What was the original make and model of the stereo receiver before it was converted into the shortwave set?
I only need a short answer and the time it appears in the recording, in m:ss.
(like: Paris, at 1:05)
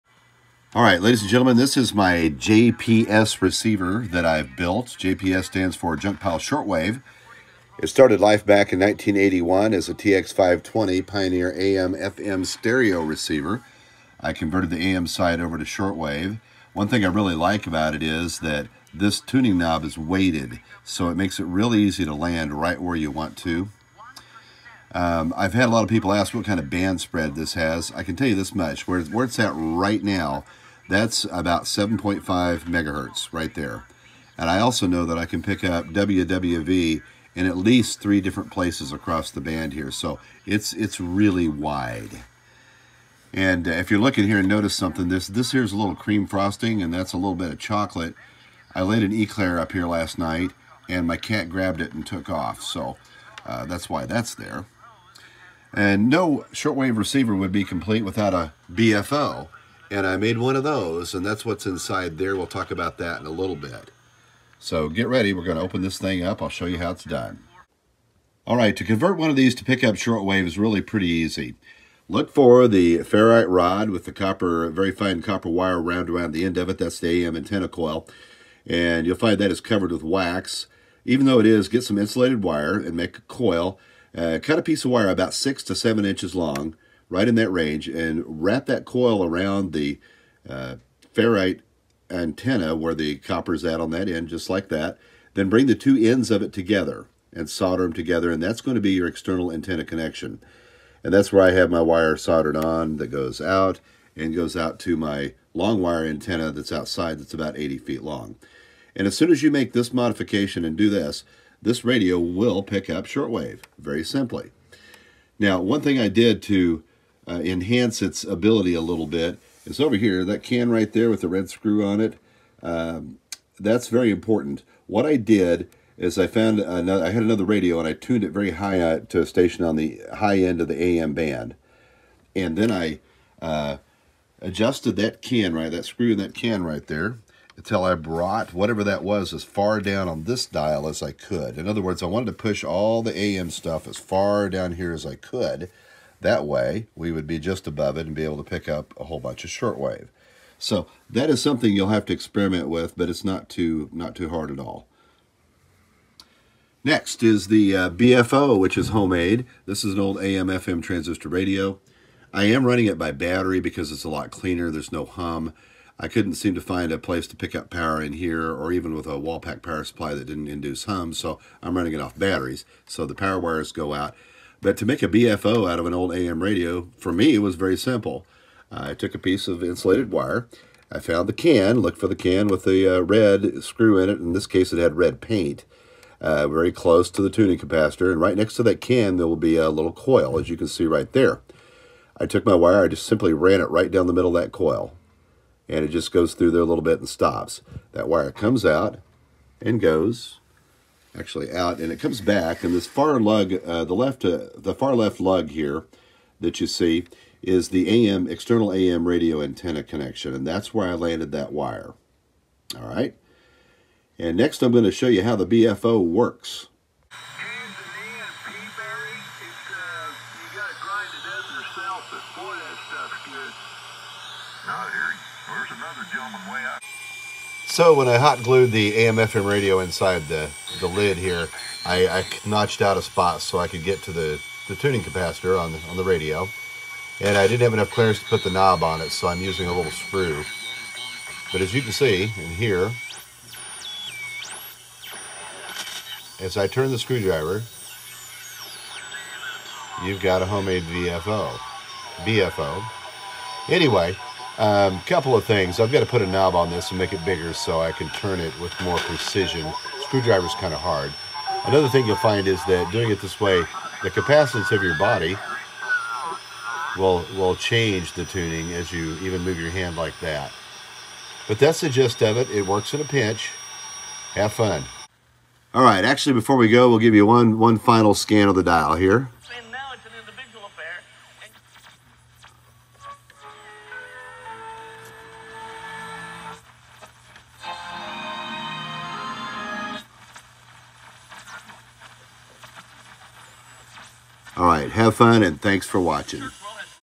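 Pioneer TX520, at 0:09.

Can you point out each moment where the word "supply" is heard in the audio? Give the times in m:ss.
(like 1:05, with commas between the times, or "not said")
2:49.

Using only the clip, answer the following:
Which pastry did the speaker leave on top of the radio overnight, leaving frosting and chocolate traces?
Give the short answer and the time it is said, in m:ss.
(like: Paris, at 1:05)
an eclair, at 0:49.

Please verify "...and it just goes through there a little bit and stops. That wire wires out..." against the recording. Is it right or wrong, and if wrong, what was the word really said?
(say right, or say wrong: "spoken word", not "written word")
wrong: "comes", not "wires".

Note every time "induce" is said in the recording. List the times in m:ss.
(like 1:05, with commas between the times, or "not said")
2:50.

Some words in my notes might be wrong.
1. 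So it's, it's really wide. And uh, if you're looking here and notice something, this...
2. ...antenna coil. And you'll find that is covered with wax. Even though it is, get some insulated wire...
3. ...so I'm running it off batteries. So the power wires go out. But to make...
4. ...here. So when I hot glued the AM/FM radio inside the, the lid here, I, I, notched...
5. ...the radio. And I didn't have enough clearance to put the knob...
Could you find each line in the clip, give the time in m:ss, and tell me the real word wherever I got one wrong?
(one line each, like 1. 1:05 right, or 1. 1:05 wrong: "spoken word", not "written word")
1. 0:39 right
2. 1:17 right
3. 2:51 right
4. 3:44 right
5. 3:55 right.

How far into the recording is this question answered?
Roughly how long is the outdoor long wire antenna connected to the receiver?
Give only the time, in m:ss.
1:47.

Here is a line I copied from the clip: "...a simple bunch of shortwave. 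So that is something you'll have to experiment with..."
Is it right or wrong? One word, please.
wrong.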